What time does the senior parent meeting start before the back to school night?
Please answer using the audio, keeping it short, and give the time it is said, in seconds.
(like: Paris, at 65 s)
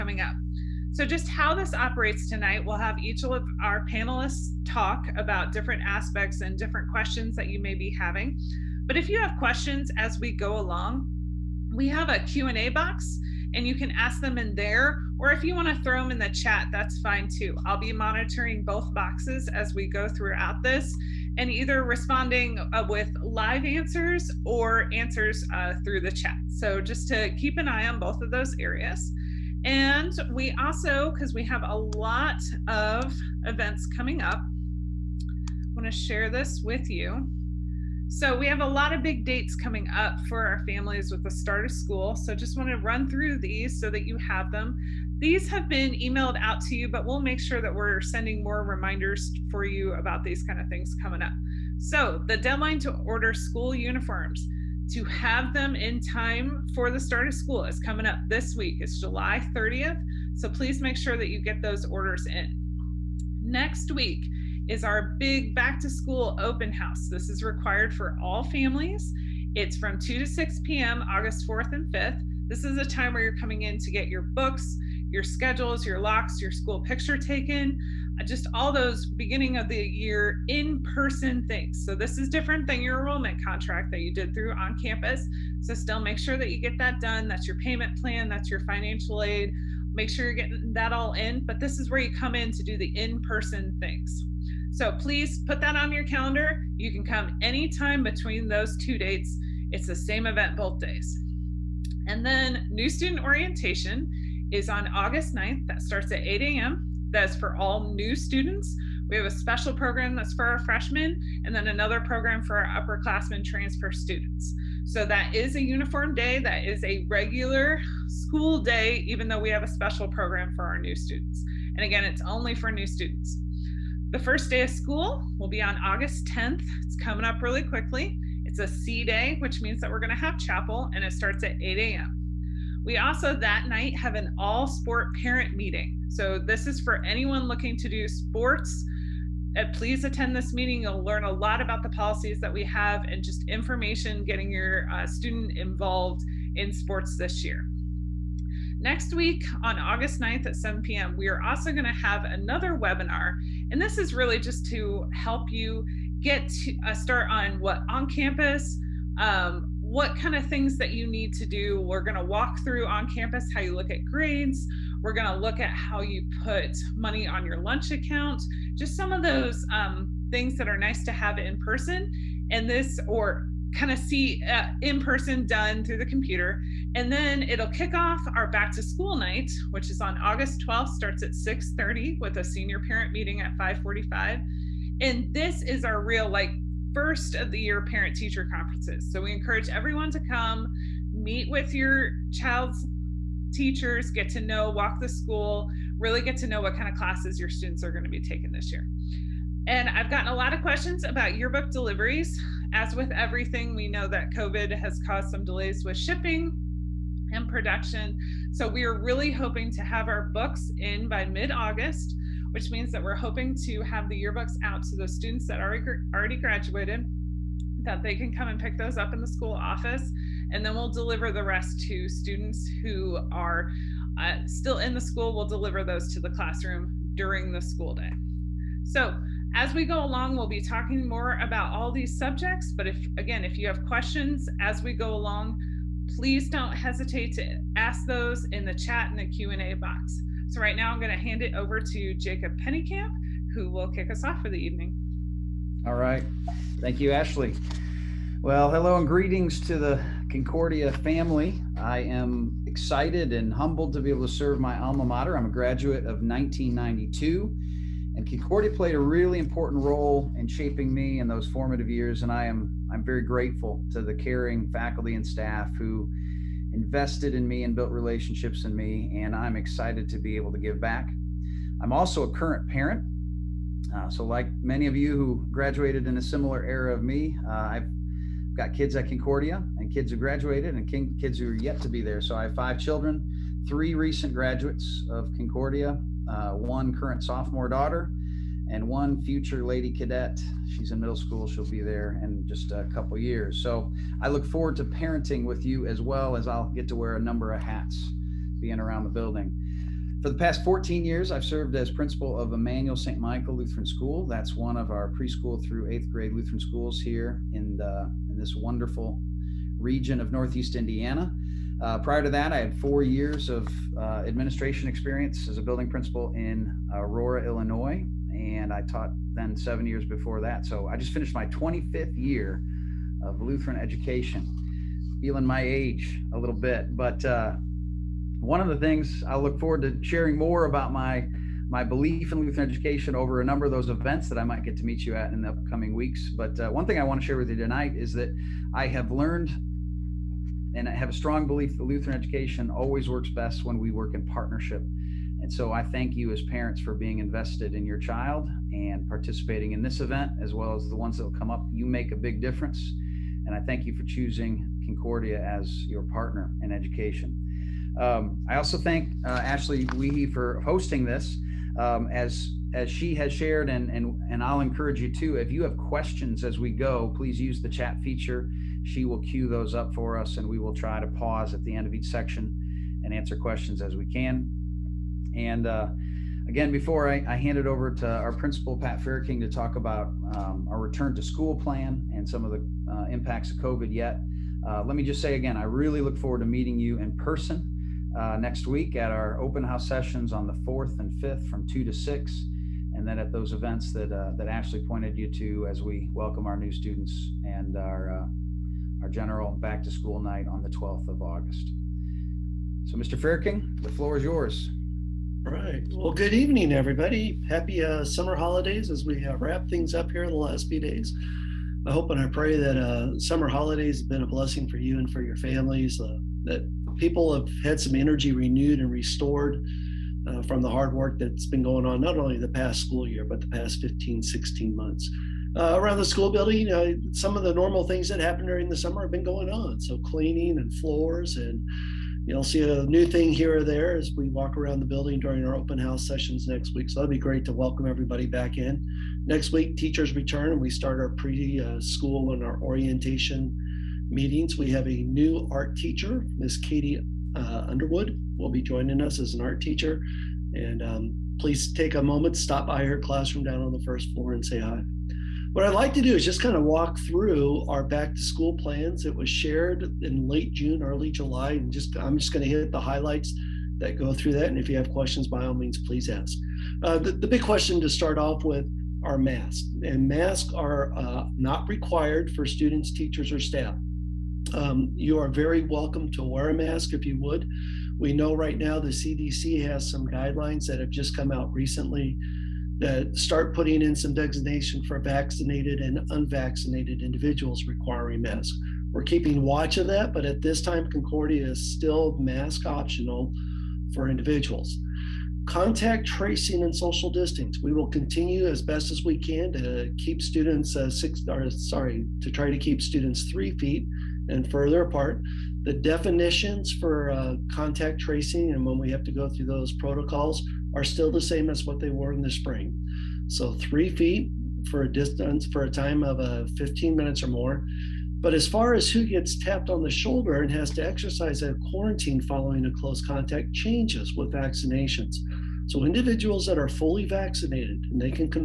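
5:45, at 183 s.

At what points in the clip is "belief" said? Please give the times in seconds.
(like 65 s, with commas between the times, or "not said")
331 s, 341 s.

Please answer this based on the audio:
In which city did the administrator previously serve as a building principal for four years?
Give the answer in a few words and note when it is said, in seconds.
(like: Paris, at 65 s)
Aurora, Illinois, at 316 s.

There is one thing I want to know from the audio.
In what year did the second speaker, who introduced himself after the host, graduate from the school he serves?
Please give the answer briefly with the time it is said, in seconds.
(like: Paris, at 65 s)
1992, at 256 s.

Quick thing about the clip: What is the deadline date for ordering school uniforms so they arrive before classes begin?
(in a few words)
July 30th.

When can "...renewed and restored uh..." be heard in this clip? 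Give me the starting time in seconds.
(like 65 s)
418 s.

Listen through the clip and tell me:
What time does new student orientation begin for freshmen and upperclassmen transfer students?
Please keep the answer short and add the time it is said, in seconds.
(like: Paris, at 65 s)
8 a.m., at 105 s.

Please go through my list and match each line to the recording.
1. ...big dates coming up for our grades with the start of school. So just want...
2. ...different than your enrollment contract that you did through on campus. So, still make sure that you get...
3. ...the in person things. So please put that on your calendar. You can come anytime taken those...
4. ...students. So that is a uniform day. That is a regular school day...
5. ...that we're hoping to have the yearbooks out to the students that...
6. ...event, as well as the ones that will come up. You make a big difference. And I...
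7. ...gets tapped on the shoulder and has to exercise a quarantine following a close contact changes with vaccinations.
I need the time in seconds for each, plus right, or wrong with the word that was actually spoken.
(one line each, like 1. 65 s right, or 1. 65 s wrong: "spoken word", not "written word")
1. 39 s wrong: "families", not "grades"
2. 82 s right
3. 92 s wrong: "between", not "taken"
4. 113 s right
5. 212 s right
6. 350 s right
7. 519 s right.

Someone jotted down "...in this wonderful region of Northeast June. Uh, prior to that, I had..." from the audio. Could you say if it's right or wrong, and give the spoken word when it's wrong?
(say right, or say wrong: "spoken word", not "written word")
wrong: "Indiana", not "June".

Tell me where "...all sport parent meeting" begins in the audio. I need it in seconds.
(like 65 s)
134 s.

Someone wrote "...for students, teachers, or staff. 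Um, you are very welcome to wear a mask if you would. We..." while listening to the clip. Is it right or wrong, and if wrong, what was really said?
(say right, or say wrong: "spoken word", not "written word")
right.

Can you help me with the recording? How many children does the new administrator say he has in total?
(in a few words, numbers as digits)
5.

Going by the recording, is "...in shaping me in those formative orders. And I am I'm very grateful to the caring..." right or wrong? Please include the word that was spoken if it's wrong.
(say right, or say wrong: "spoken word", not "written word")
wrong: "years", not "orders".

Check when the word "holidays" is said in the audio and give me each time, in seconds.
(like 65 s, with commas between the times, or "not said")
408 s, 413 s.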